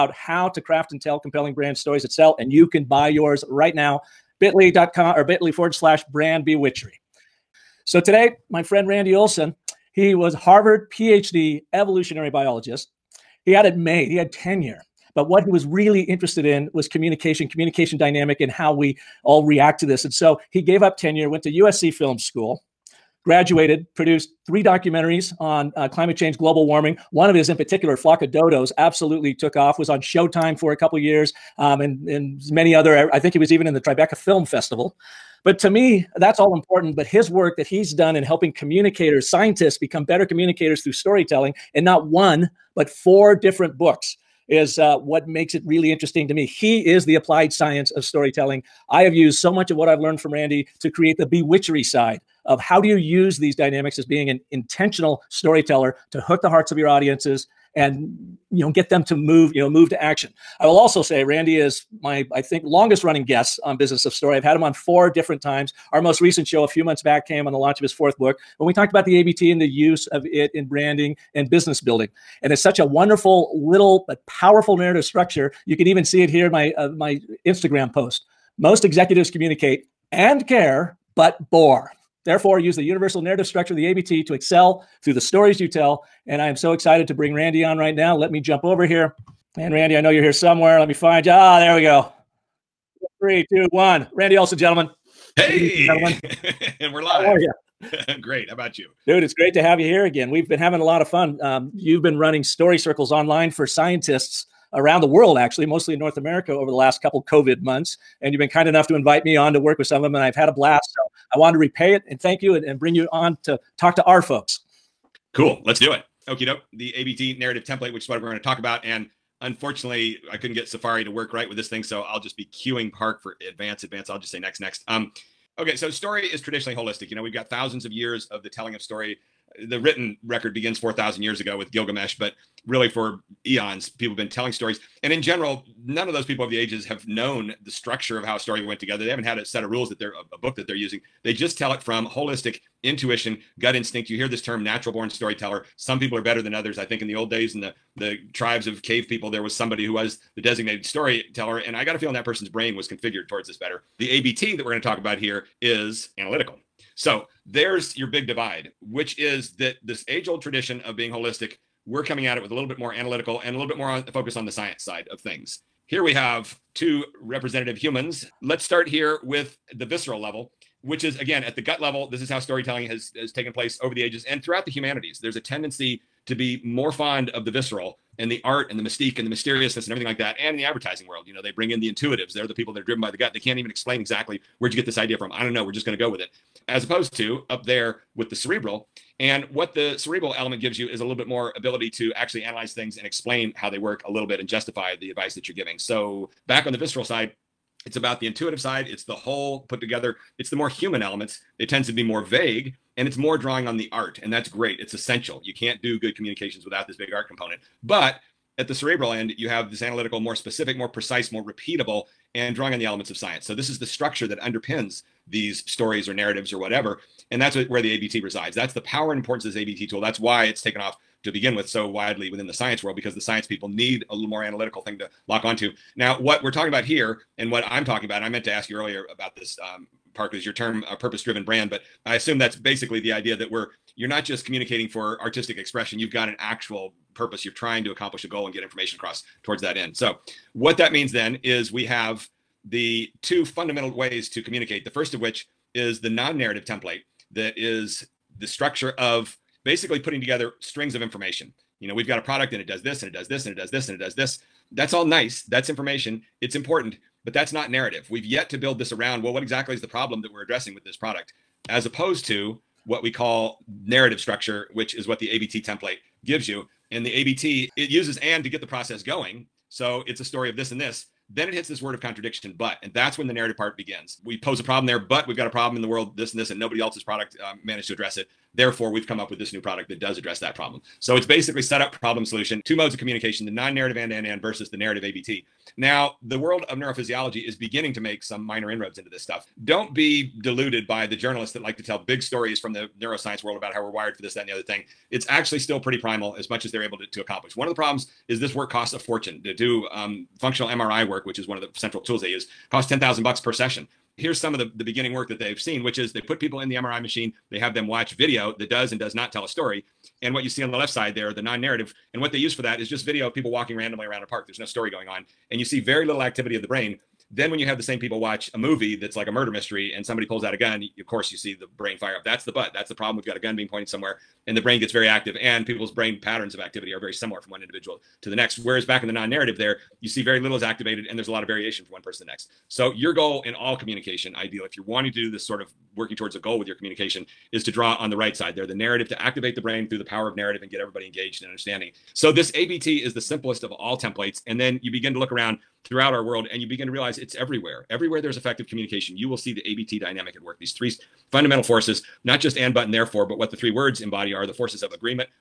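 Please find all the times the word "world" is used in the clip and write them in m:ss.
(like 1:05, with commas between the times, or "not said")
1:45, 3:01, 3:42, 4:35, 4:46, 4:53, 5:46.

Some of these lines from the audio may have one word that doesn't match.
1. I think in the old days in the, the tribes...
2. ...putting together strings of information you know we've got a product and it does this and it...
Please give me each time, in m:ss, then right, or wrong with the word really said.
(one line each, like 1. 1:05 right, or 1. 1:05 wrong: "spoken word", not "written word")
1. 2:26 right
2. 4:09 right.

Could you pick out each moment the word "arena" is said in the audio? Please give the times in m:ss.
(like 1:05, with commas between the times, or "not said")
not said.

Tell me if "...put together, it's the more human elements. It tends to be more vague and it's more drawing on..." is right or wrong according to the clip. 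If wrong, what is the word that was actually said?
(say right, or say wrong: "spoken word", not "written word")
right.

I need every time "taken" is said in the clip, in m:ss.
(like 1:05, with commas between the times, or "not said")
2:53, 3:40.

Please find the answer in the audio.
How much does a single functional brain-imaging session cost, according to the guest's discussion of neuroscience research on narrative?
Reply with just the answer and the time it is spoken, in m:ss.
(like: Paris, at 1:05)
$10,000, at 5:02.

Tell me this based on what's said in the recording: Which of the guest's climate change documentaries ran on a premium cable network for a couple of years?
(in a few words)
Flock of Dodos.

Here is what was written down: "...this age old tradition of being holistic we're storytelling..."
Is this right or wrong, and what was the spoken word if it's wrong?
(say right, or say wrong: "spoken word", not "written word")
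wrong: "coming", not "storytelling".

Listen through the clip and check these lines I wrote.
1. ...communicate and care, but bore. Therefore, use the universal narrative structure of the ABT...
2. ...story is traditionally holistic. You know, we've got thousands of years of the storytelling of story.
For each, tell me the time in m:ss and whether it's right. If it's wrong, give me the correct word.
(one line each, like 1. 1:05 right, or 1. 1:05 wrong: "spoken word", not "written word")
1. 1:19 right
2. 2:05 wrong: "telling", not "storytelling".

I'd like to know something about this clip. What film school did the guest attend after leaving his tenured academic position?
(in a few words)
USC Film School.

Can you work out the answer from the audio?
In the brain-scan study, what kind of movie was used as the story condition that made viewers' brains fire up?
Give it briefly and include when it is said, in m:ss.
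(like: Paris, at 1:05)
a murder mystery, at 5:19.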